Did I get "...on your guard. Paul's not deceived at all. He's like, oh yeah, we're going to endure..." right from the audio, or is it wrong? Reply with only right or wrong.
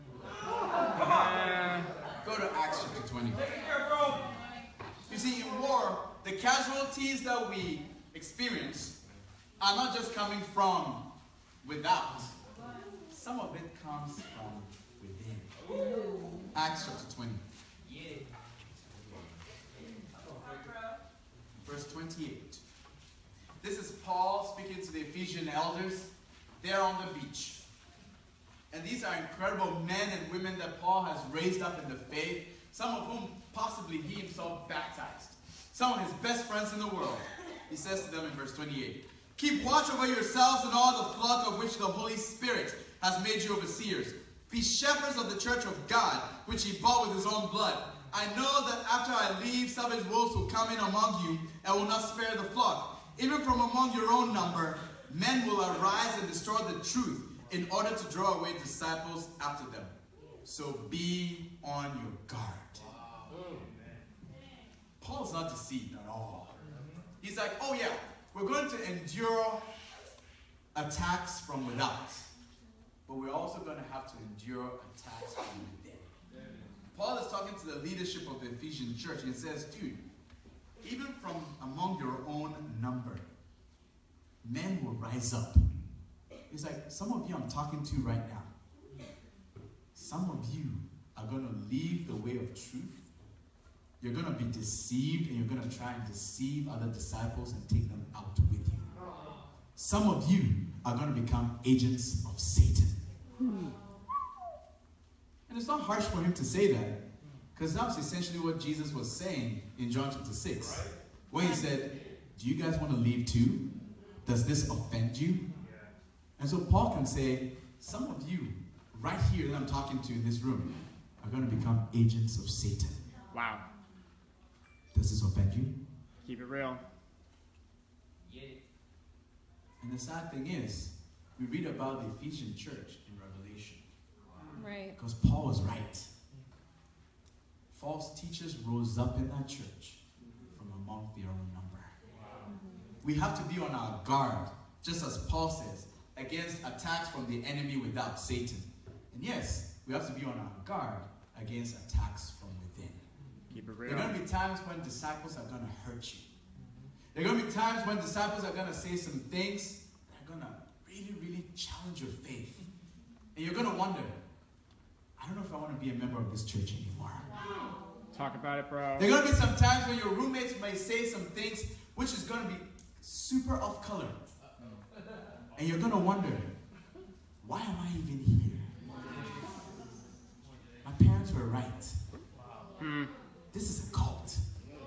right.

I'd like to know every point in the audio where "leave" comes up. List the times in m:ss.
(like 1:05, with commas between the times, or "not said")
0:49, 1:31, 1:52.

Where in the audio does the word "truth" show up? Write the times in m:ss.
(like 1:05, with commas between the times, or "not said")
0:56, 1:32.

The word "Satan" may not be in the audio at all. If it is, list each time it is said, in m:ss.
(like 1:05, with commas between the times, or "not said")
1:42, 2:02, 2:28.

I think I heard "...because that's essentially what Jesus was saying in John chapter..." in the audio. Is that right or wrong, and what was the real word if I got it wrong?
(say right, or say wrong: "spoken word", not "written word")
right.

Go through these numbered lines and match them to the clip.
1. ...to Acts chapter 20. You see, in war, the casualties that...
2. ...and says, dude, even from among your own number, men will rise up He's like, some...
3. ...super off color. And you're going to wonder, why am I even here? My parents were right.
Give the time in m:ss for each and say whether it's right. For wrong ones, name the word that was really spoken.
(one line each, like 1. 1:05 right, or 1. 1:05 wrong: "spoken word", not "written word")
1. 0:02 right
2. 1:19 right
3. 2:53 right.